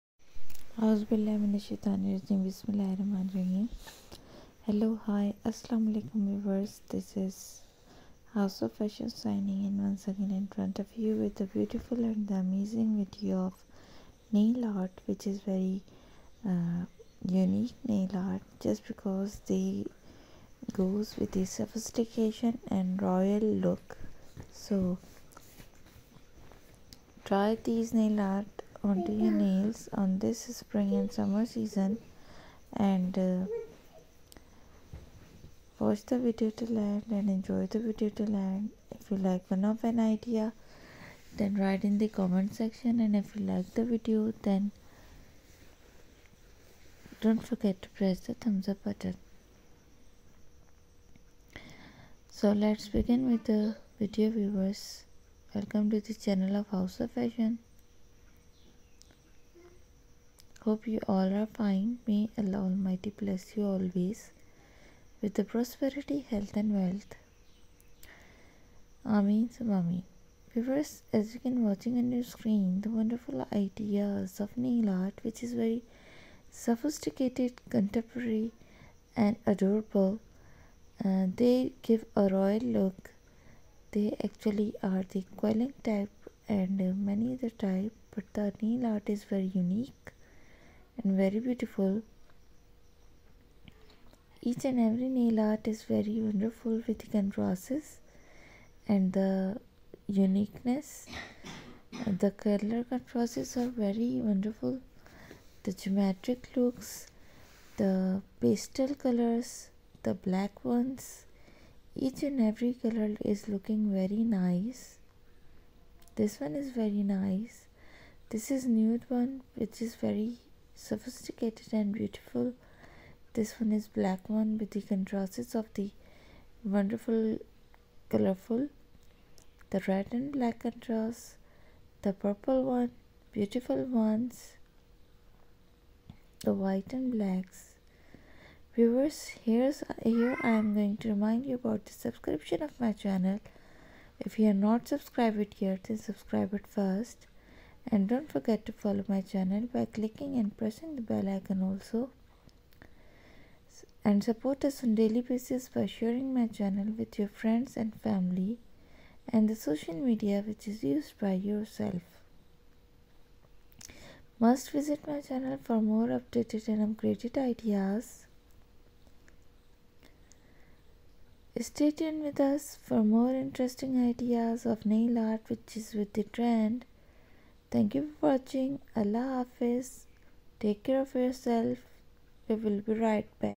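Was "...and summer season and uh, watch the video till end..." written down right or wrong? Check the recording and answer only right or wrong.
right.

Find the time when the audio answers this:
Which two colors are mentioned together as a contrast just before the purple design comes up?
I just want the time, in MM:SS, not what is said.
02:09.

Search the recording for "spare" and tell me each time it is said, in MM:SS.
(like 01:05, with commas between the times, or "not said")
not said.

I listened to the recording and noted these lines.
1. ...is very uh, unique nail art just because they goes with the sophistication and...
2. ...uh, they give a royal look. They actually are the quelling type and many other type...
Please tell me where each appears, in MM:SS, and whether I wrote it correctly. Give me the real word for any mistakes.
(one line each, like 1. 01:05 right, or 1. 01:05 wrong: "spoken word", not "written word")
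1. 00:15 right
2. 01:21 right.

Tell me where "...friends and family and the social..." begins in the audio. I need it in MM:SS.
02:37.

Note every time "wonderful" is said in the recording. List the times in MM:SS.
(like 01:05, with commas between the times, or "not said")
01:12, 01:36, 01:44, 02:06.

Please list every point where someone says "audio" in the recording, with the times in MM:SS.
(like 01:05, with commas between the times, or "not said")
not said.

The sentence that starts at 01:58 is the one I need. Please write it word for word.
This is nude one which is very sophisticated and beautiful.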